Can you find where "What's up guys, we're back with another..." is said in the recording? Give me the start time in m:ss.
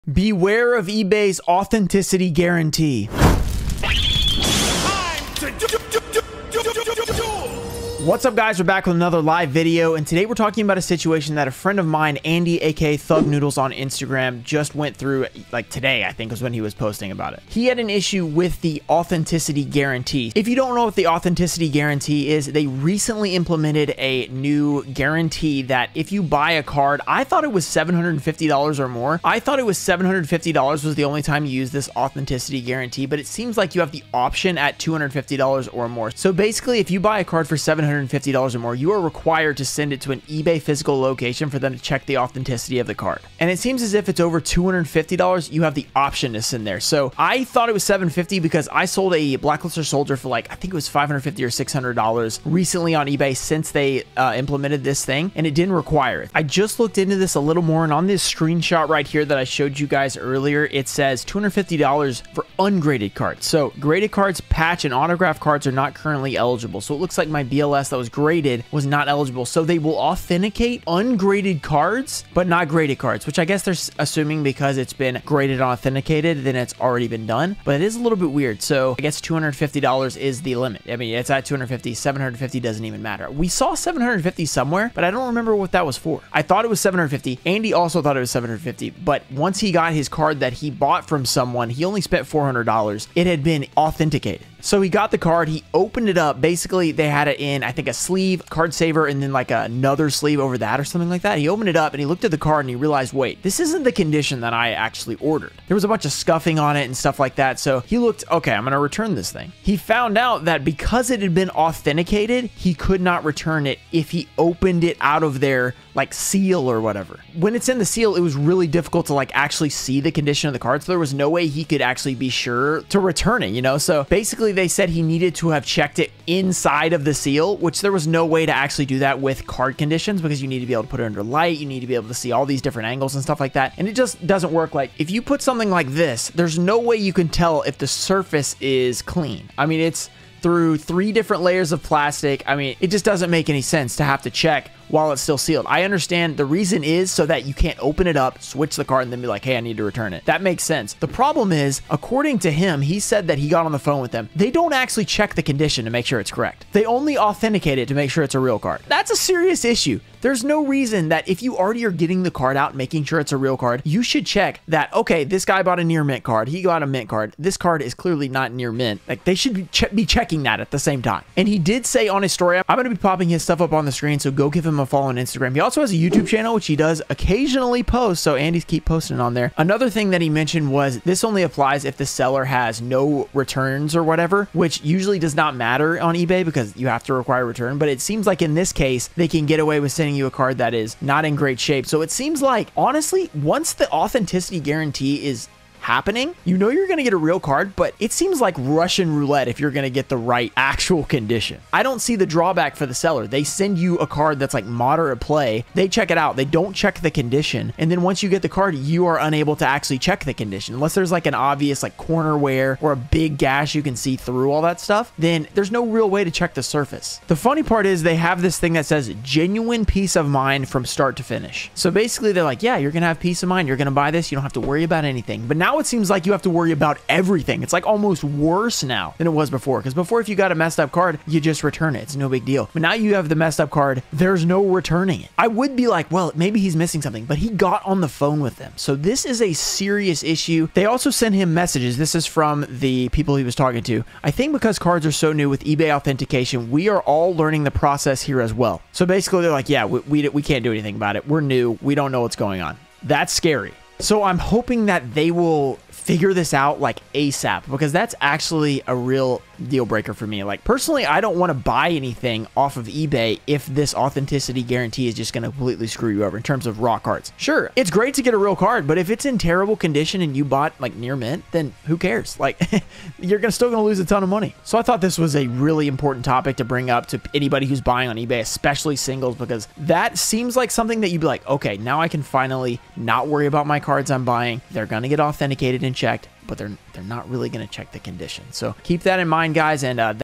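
0:08.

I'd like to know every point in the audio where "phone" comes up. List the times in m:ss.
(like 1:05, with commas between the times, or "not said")
2:33, 3:58.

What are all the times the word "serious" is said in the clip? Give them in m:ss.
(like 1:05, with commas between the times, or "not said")
2:39, 3:59.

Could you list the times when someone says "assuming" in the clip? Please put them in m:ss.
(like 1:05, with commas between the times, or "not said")
1:13.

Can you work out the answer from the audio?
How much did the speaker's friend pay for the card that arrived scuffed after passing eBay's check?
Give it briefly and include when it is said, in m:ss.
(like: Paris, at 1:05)
$400, at 1:32.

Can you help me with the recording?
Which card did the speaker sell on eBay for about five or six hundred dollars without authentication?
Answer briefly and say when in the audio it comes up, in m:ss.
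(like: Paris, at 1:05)
Black Luster Soldier, at 0:49.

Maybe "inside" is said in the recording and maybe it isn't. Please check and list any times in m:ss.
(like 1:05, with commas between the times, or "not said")
2:06.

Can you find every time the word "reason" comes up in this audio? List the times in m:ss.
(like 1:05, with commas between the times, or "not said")
2:26, 2:40.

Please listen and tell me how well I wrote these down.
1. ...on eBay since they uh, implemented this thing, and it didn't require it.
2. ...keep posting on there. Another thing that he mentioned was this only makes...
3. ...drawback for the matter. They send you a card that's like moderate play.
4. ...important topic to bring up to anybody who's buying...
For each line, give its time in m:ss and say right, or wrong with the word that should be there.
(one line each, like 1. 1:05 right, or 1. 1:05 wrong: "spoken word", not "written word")
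1. 0:52 right
2. 2:58 wrong: "applies", not "makes"
3. 3:22 wrong: "seller", not "matter"
4. 4:35 right.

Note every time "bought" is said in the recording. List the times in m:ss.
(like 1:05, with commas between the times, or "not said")
1:30, 2:45, 4:30.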